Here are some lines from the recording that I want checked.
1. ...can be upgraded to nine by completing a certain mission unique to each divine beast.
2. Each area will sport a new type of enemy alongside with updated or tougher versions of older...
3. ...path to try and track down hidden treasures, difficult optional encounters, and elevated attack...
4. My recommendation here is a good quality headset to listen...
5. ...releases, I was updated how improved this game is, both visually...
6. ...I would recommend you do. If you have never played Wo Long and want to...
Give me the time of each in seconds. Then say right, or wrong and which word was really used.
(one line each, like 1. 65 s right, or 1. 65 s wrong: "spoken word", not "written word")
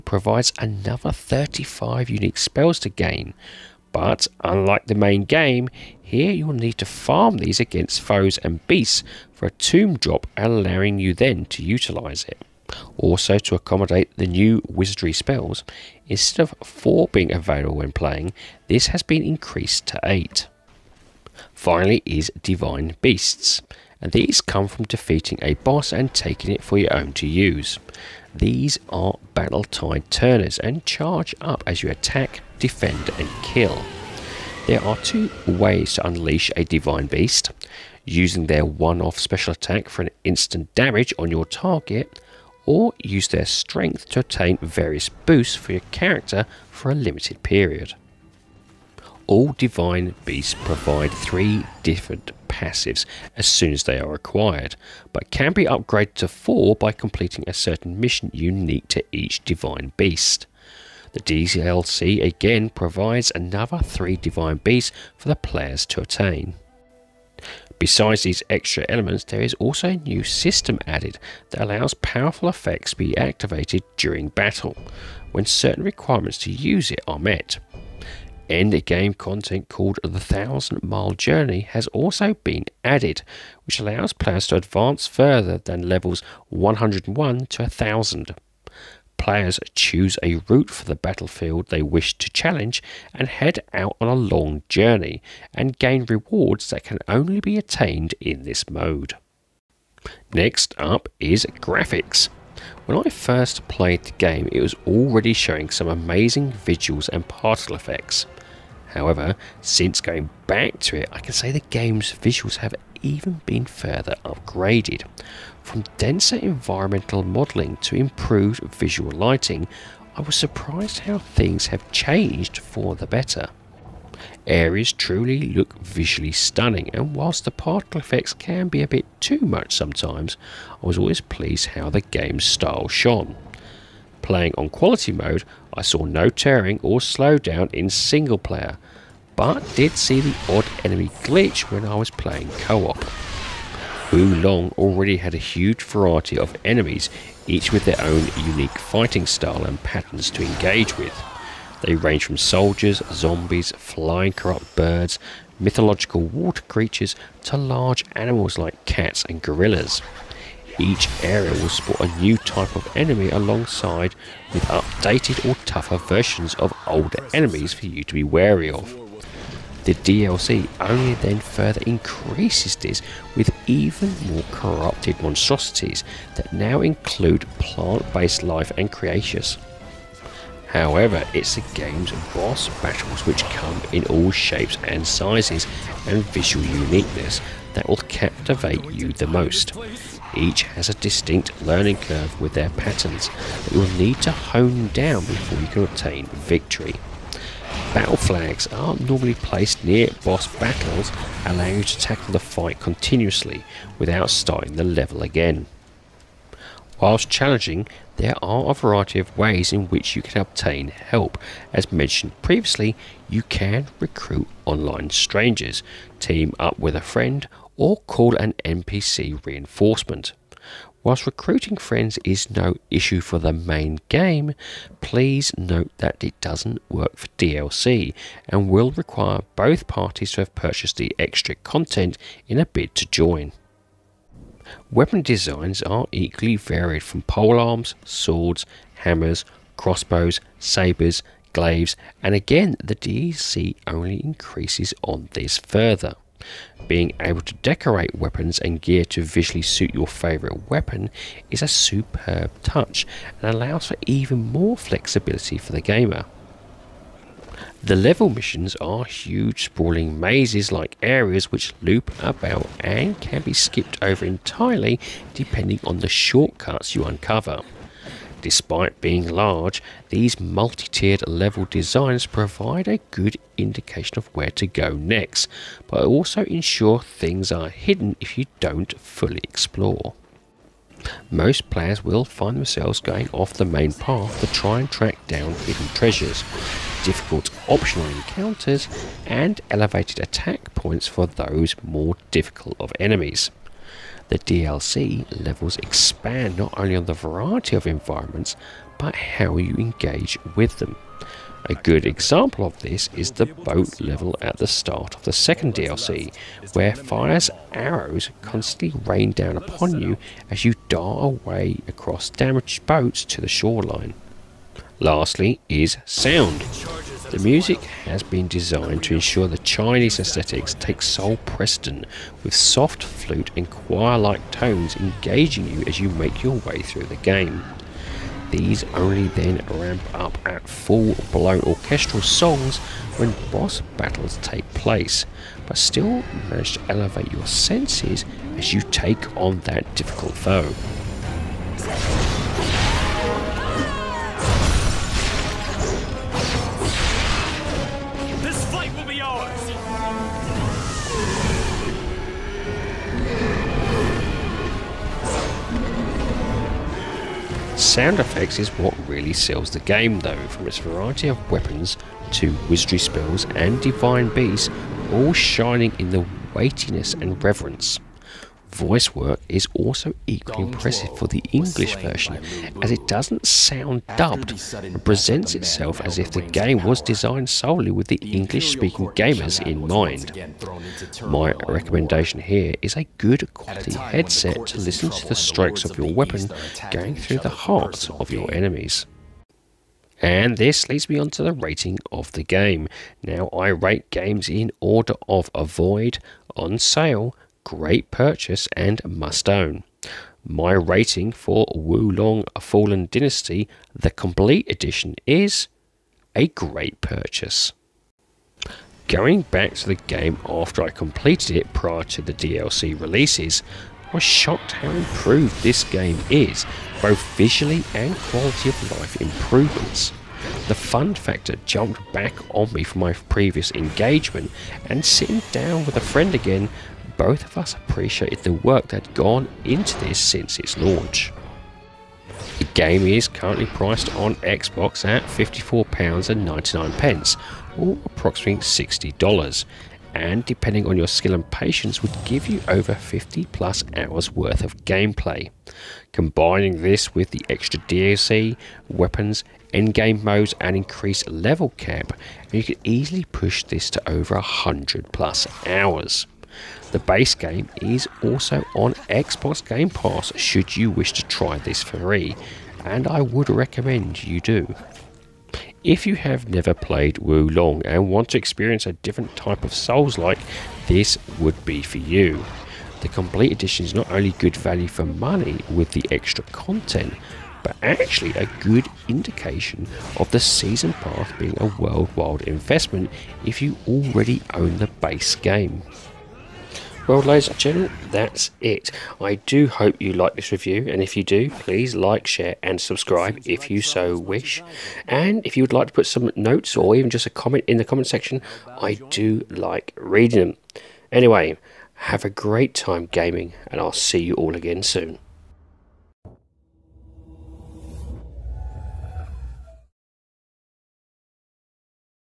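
1. 55 s wrong: "four", not "nine"
2. 160 s right
3. 283 s right
4. 381 s right
5. 412 s wrong: "shocked", not "updated"
6. 463 s right.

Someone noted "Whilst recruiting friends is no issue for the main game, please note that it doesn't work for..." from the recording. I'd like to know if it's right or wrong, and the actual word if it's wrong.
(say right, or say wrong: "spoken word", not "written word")
right.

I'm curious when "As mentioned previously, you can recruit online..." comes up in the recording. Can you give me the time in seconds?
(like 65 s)
211 s.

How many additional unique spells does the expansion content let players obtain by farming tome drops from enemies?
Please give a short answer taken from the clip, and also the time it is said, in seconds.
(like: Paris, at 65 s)
35, at 1 s.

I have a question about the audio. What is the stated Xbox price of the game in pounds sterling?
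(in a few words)
£54.99.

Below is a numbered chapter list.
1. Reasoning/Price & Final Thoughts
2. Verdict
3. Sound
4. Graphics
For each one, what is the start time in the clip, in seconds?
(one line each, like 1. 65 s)
1. 408 s
2. 389 s
3. 315 s
4. 99 s.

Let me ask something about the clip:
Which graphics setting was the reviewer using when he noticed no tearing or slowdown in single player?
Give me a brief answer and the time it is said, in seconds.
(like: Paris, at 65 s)
Quality mode, at 134 s.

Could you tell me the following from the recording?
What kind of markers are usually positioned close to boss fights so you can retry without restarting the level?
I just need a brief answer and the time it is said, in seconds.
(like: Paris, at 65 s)
Battle flags, at 197 s.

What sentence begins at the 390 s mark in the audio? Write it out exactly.
And this leads me on to the rating of the game.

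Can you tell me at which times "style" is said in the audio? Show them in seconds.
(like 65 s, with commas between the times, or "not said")
132 s, 149 s.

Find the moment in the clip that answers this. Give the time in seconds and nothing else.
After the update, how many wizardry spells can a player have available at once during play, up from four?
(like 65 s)
20 s.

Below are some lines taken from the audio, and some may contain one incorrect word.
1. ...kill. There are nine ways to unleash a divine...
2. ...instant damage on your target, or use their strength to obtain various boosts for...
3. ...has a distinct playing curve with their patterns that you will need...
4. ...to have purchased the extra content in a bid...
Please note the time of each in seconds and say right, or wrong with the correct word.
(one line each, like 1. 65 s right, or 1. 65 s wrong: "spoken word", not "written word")
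1. 33 s wrong: "two", not "nine"
2. 40 s right
3. 190 s wrong: "learning", not "playing"
4. 230 s right.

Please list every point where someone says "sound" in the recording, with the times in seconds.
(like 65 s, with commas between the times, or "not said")
316 s, 357 s, 373 s.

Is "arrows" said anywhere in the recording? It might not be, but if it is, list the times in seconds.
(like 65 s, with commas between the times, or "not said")
307 s.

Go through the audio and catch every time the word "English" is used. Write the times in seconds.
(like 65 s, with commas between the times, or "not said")
371 s, 378 s.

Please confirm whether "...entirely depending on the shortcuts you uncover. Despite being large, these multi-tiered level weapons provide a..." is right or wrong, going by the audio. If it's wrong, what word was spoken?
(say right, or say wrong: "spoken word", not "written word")
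wrong: "designs", not "weapons".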